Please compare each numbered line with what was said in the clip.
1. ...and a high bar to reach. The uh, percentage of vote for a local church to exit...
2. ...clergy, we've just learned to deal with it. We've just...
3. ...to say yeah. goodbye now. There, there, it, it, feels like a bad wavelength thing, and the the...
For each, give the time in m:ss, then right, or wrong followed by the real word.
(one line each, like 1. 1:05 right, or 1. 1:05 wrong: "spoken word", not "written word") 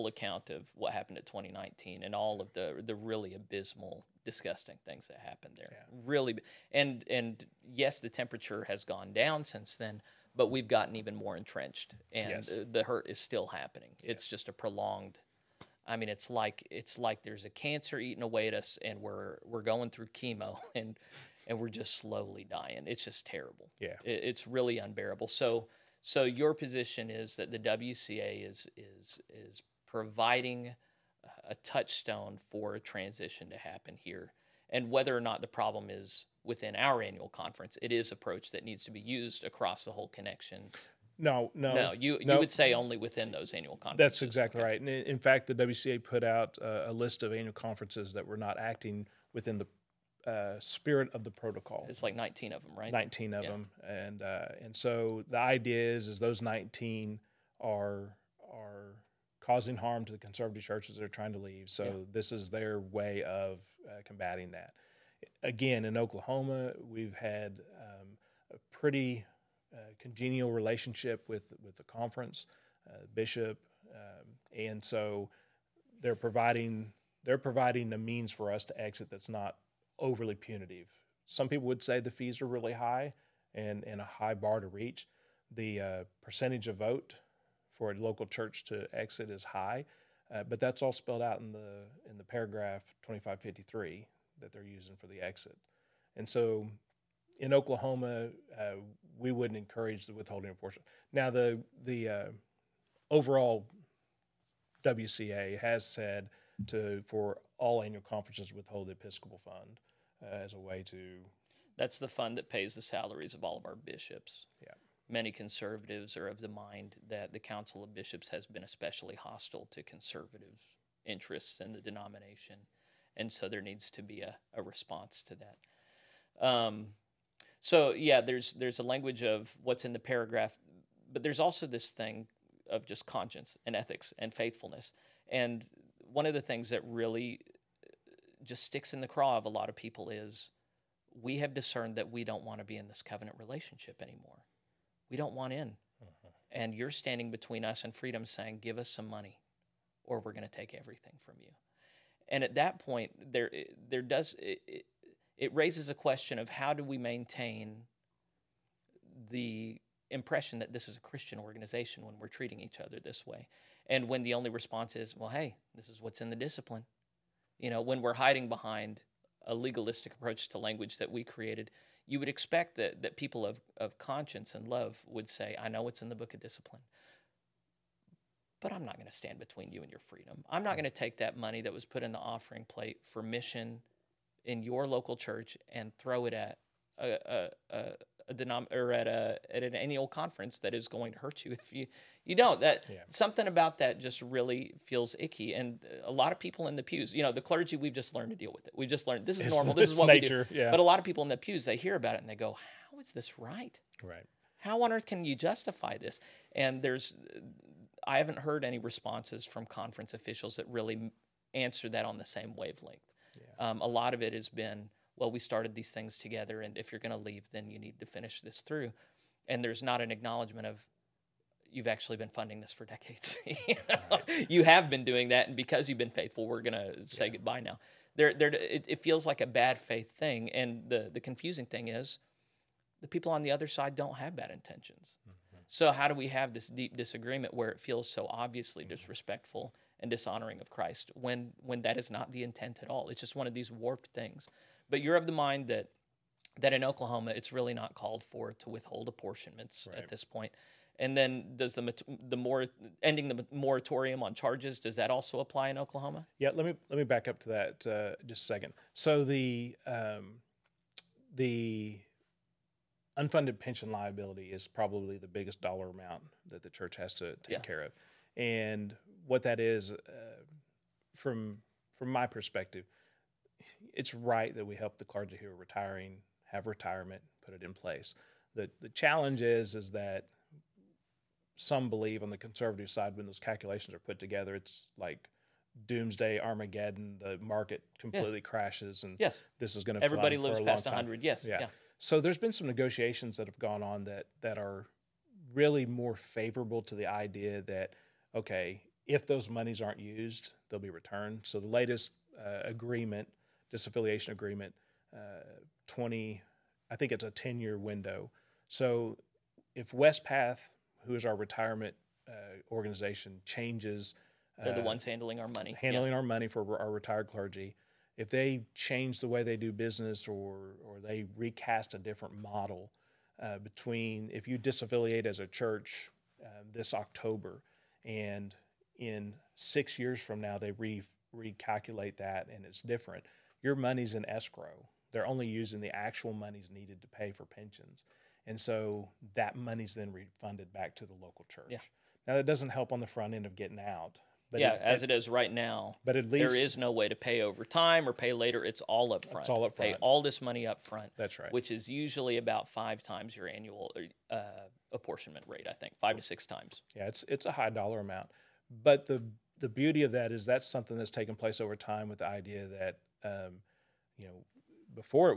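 1. 1:23 right
2. 3:17 right
3. 3:46 wrong: "faith", not "wavelength".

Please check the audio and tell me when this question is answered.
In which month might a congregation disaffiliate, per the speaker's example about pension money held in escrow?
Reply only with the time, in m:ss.
5:26.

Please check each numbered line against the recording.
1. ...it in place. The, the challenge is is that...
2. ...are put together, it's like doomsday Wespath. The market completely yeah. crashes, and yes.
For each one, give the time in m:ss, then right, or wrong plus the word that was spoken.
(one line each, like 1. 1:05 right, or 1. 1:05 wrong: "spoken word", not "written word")
1. 4:37 right
2. 4:43 wrong: "Armageddon", not "Wespath".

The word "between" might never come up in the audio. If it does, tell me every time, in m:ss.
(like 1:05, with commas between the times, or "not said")
2:27, 2:59, 5:23.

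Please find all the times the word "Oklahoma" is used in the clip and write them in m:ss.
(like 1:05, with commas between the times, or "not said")
1:05, 1:37, 4:06, 4:15.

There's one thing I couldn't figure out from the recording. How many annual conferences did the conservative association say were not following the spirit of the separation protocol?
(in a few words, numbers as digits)
19.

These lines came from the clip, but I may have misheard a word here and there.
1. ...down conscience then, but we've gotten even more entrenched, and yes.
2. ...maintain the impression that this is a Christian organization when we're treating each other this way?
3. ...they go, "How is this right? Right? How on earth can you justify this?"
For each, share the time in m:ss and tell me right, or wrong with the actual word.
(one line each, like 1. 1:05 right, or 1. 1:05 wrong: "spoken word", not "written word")
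1. 0:09 wrong: "since", not "conscience"
2. 2:36 right
3. 3:22 right.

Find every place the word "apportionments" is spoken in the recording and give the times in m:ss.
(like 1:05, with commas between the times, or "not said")
4:09, 5:54.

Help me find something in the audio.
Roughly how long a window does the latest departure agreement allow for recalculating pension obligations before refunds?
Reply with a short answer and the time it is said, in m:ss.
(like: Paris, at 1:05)
10 years, at 5:07.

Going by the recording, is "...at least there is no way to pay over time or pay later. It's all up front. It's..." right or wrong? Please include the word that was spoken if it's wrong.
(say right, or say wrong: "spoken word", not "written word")
right.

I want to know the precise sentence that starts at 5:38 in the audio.
And so that money's then refunded back to the local church.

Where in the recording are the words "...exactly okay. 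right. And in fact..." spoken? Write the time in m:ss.
0:44.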